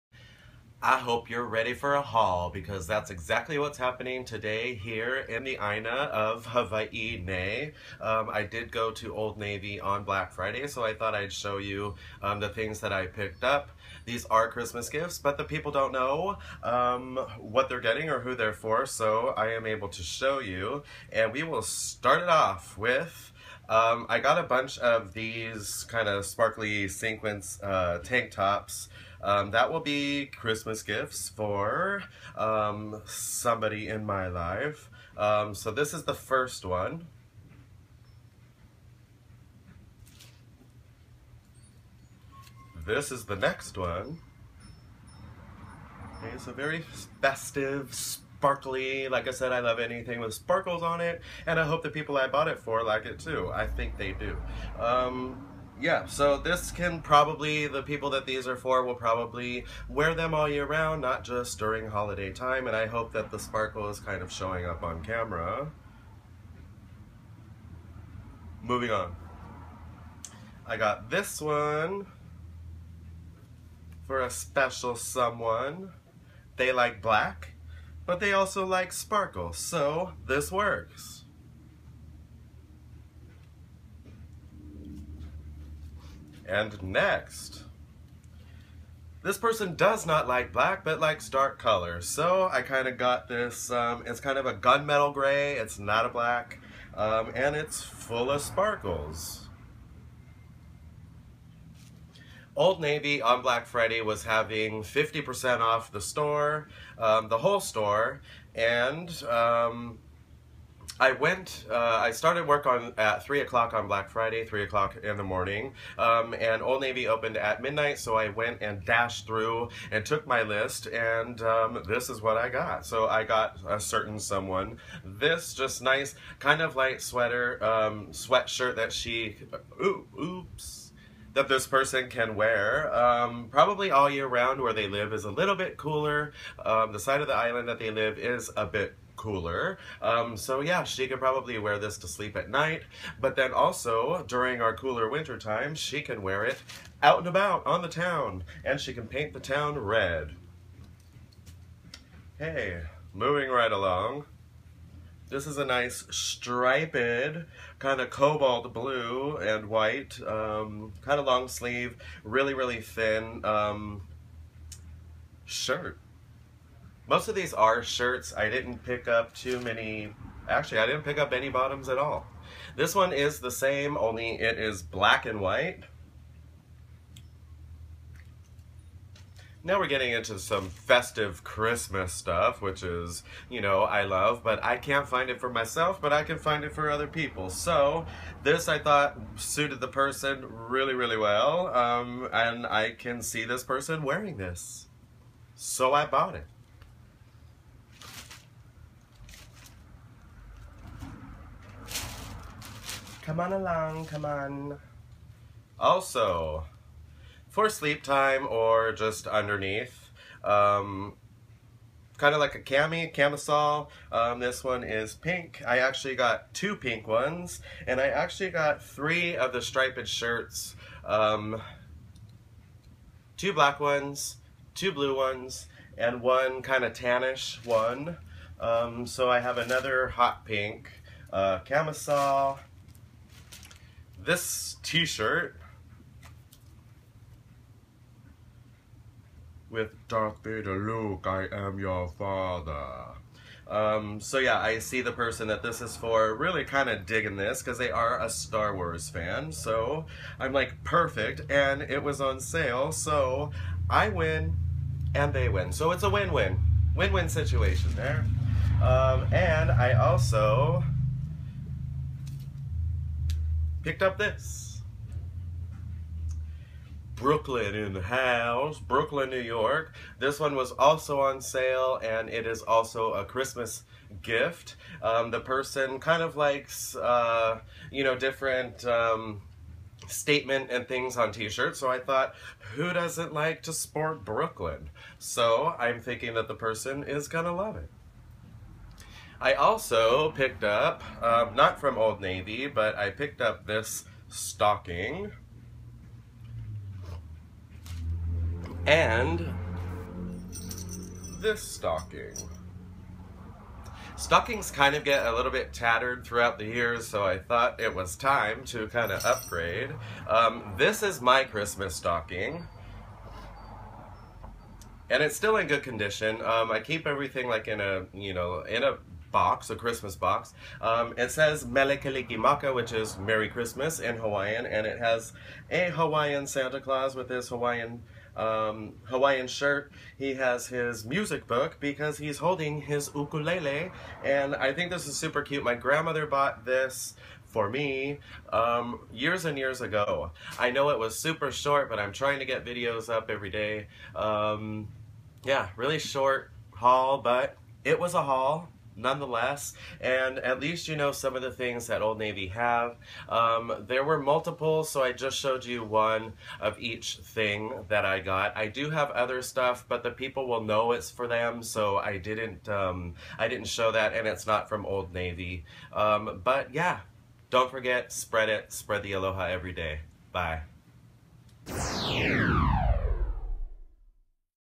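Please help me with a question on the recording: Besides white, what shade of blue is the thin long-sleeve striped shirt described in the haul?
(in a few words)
cobalt blue.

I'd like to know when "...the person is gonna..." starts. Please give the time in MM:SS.
04:46.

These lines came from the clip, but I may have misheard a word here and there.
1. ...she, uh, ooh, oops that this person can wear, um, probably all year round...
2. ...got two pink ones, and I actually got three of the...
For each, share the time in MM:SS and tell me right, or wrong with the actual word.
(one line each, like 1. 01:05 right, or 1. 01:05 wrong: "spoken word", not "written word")
1. 02:08 right
2. 03:36 right.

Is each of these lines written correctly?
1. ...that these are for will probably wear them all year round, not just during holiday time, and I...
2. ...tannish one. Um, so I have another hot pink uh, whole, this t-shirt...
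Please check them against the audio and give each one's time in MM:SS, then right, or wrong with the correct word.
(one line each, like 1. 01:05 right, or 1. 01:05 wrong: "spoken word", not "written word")
1. 00:58 right
2. 03:46 wrong: "camisole", not "whole".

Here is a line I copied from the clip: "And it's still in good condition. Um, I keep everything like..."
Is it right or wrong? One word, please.
right.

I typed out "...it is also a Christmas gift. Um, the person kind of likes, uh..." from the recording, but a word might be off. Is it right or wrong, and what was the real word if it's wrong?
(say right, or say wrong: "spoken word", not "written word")
right.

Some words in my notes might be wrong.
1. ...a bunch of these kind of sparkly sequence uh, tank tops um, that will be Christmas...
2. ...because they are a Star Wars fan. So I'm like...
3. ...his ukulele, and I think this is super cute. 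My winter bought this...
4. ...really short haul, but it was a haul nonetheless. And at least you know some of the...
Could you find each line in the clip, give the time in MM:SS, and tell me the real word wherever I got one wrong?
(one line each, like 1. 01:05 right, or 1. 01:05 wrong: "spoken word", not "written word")
1. 00:24 right
2. 04:07 right
3. 05:32 wrong: "grandmother", not "winter"
4. 05:45 right.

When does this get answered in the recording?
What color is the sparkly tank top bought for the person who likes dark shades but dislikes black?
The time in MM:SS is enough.
01:34.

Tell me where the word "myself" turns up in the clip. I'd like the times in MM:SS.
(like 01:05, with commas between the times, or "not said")
03:05.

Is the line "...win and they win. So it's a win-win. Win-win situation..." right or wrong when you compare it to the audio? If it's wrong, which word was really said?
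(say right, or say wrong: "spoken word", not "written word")
right.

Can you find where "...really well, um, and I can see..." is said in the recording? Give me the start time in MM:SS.
03:10.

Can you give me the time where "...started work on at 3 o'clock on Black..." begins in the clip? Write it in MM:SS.
01:52.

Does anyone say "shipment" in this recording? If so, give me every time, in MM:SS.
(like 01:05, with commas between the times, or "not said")
not said.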